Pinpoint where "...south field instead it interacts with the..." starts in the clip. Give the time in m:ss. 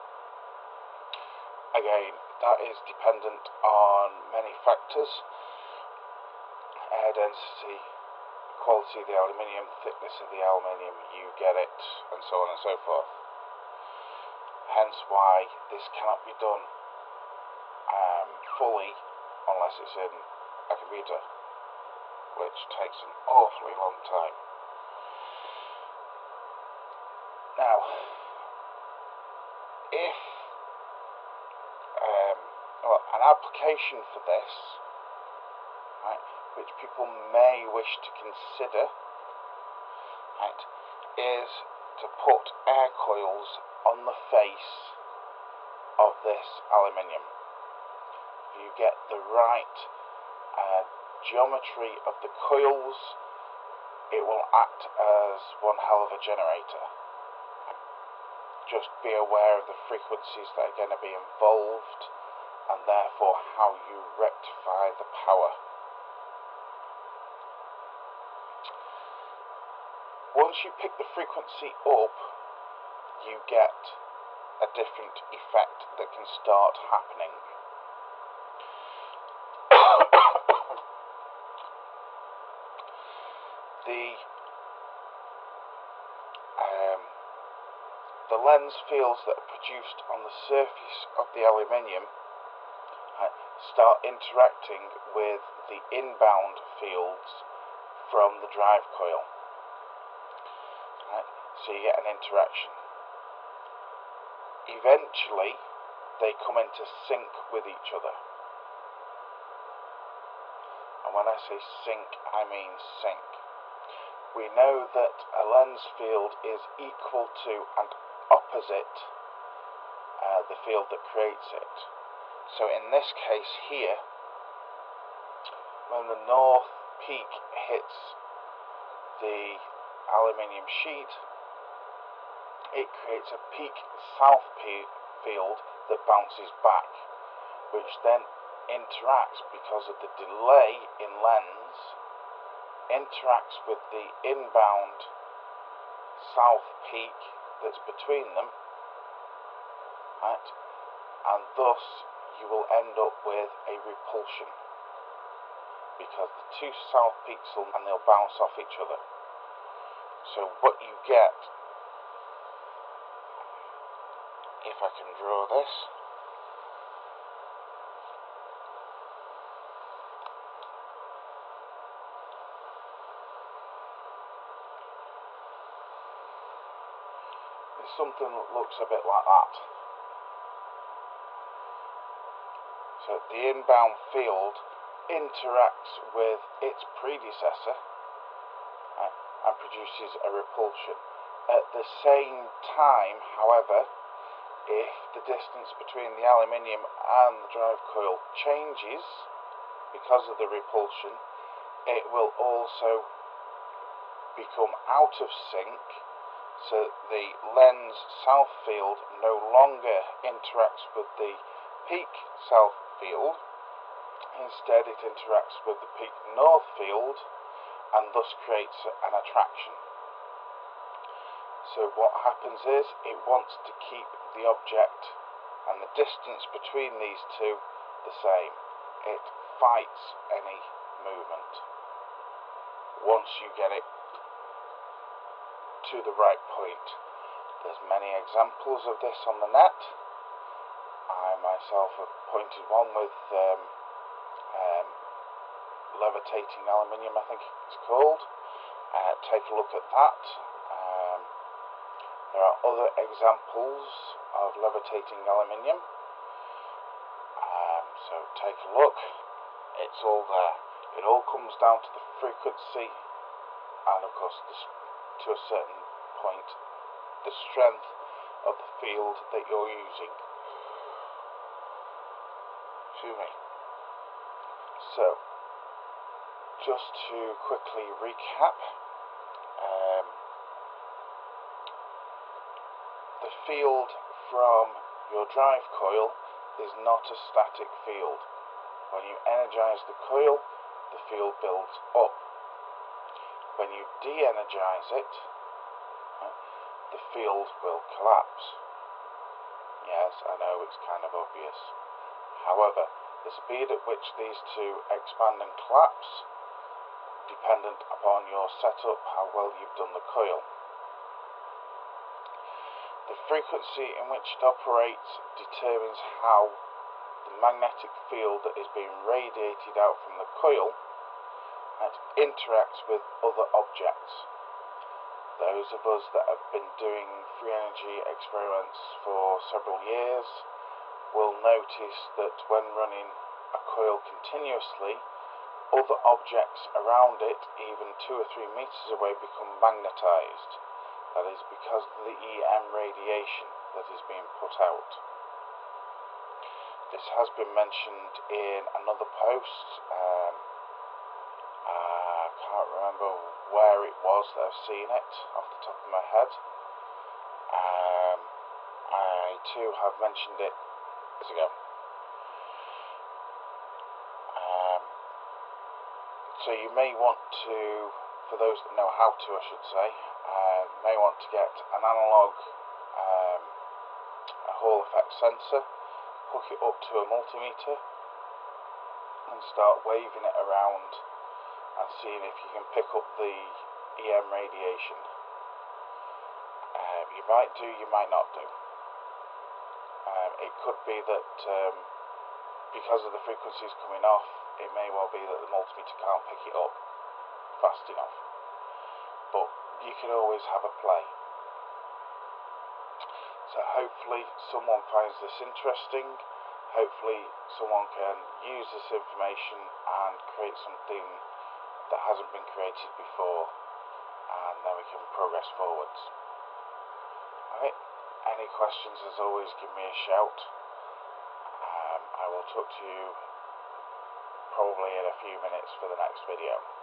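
3:32.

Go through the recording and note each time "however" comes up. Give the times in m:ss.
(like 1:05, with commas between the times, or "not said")
3:13, 5:02.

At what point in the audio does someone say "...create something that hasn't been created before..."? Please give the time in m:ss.
6:50.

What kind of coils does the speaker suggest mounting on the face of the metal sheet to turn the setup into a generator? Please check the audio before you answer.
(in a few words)
air coils.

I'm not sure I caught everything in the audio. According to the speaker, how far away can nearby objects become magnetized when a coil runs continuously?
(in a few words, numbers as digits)
two or three meters.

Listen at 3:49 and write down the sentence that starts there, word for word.
It fights any movement once you get it to the right point.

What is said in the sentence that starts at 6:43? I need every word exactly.
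So hopefully someone finds this interesting.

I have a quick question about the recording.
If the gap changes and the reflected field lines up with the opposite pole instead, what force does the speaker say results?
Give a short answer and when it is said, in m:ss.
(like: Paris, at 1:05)
attraction, at 3:39.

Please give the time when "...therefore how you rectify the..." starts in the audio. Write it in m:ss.
1:02.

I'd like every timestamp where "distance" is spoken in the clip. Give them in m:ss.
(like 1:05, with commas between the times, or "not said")
3:15, 3:45.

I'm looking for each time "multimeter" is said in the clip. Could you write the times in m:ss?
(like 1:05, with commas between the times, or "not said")
6:17, 6:35.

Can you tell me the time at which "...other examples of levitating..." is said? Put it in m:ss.
4:12.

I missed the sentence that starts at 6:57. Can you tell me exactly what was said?
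Alright, any questions as always give me a shout.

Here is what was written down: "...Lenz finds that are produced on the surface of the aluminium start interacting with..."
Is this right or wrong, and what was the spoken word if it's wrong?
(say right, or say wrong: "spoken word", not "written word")
wrong: "fields", not "finds".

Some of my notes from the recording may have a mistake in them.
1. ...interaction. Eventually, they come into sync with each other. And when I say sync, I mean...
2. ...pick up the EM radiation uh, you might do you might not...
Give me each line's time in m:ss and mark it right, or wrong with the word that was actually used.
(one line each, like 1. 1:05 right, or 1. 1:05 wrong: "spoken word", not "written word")
1. 1:42 right
2. 6:22 right.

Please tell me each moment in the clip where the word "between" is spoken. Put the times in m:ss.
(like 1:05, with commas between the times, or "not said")
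2:27, 3:15, 3:46.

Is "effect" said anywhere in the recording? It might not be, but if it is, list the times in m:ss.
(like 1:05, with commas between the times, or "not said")
1:15, 6:14.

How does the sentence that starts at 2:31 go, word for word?
And thus you will end up with a repulsion because the two south peaks will and they'll bounce off each other.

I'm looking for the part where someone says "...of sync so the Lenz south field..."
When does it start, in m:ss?
3:25.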